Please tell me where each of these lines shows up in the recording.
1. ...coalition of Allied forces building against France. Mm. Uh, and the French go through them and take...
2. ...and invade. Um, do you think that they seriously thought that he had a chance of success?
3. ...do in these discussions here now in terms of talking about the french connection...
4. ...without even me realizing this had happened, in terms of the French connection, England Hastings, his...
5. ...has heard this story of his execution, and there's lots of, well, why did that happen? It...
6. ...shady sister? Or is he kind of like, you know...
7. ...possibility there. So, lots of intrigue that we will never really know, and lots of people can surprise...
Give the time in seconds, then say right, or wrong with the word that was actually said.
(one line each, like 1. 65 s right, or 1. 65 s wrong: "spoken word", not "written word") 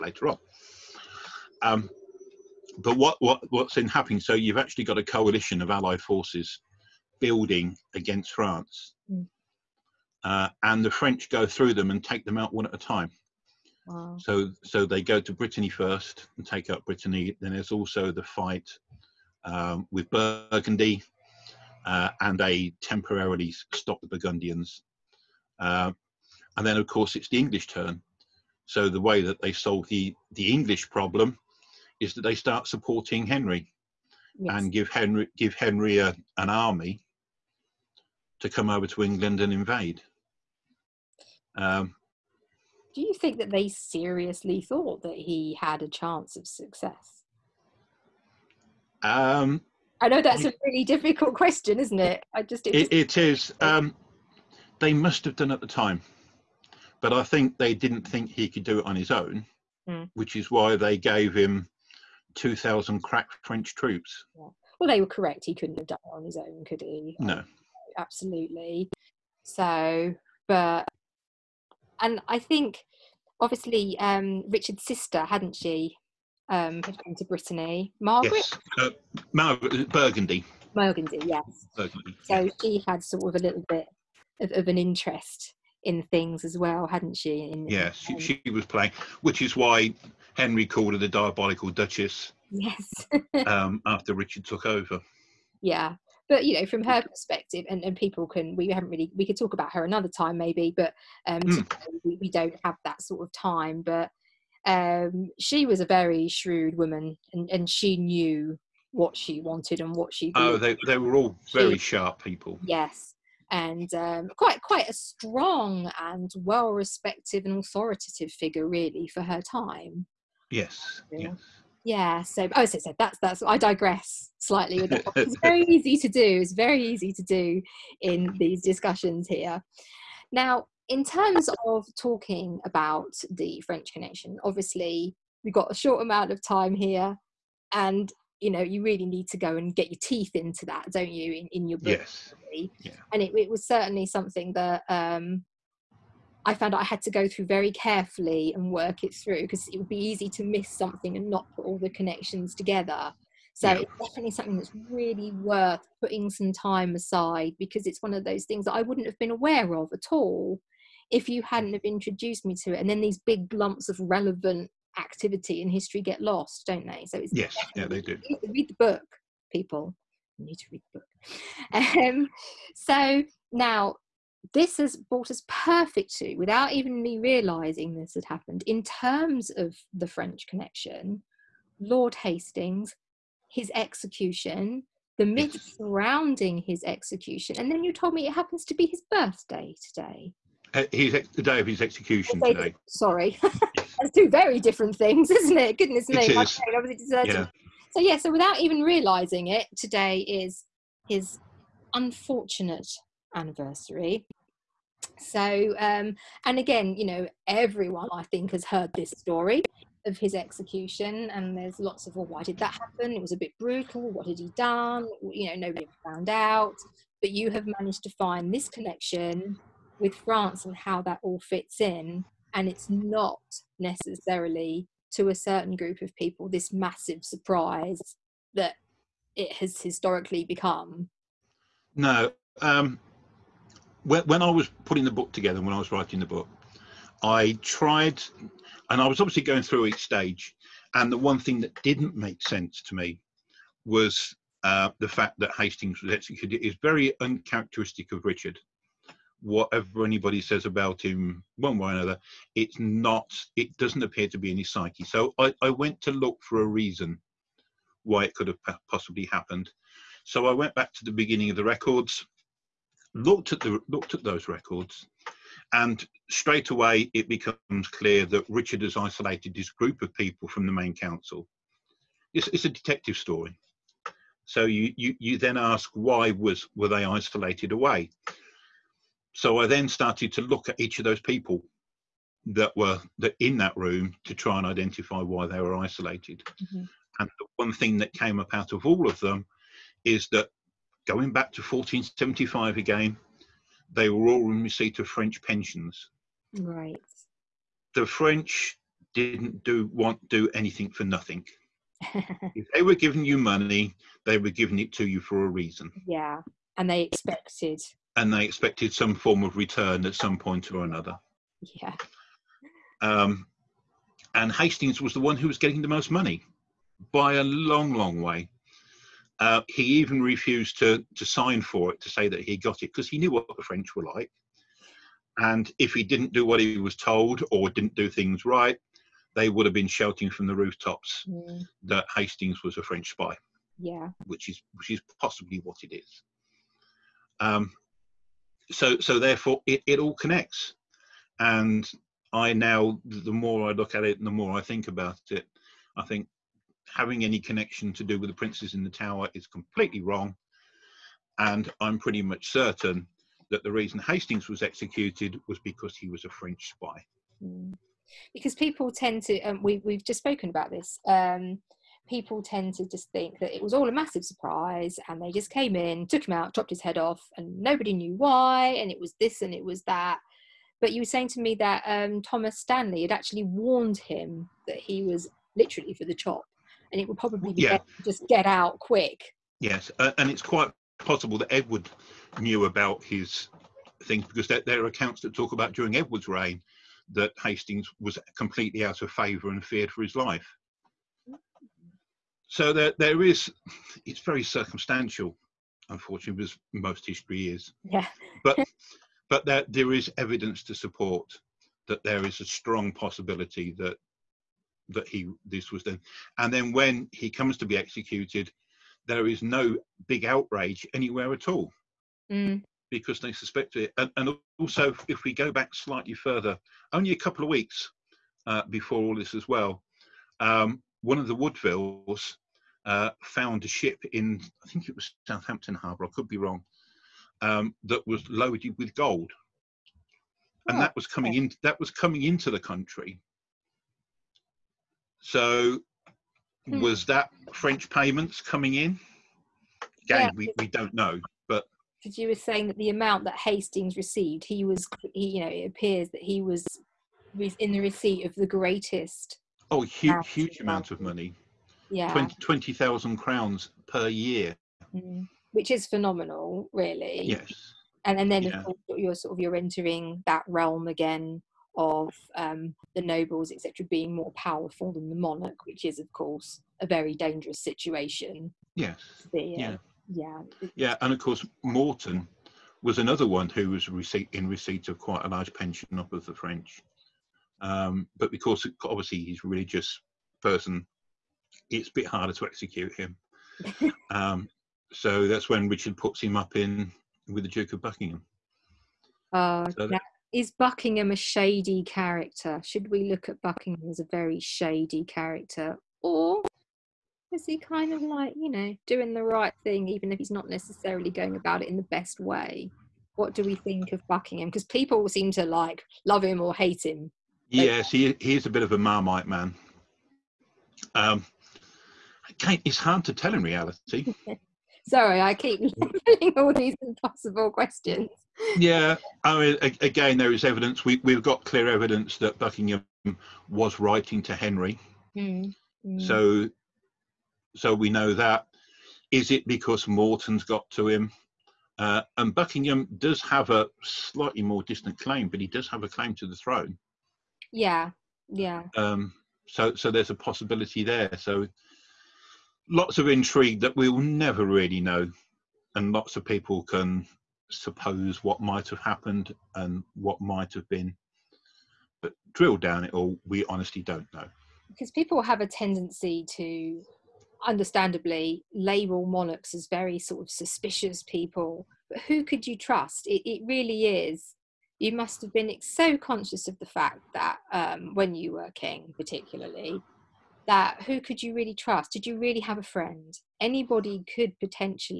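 1. 5 s right
2. 39 s right
3. 127 s right
4. 176 s wrong: "Lord", not "England"
5. 208 s right
6. 494 s wrong: "character", not "sister"
7. 540 s wrong: "suppose", not "surprise".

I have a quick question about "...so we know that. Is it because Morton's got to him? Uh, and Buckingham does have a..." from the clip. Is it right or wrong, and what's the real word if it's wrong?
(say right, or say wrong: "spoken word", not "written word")
right.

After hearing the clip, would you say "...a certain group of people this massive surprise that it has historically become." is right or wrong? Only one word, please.
right.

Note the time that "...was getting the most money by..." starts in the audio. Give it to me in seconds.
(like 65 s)
315 s.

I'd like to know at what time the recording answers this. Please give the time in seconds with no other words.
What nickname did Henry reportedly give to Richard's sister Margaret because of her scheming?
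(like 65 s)
90 s.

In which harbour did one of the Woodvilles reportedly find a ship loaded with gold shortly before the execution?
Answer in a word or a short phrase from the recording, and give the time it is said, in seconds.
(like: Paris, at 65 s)
Southampton Harbour, at 425 s.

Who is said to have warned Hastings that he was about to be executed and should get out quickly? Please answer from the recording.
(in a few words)
Thomas Stanley.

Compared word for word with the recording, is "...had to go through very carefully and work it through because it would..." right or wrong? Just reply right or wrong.
right.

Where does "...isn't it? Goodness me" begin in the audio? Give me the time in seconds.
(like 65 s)
195 s.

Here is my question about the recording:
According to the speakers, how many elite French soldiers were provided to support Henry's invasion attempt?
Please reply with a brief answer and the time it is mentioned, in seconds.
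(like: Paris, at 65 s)
2000, at 62 s.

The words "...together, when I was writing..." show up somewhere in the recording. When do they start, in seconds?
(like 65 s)
235 s.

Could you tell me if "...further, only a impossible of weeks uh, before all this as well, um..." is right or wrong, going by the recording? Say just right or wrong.
wrong.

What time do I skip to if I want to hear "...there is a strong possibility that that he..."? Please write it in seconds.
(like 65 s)
402 s.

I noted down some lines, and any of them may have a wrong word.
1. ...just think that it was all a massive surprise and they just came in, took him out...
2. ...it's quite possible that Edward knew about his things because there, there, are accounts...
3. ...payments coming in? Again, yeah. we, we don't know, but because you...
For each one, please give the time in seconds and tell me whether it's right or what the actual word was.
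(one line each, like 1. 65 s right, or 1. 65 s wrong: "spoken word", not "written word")
1. 362 s right
2. 380 s right
3. 437 s right.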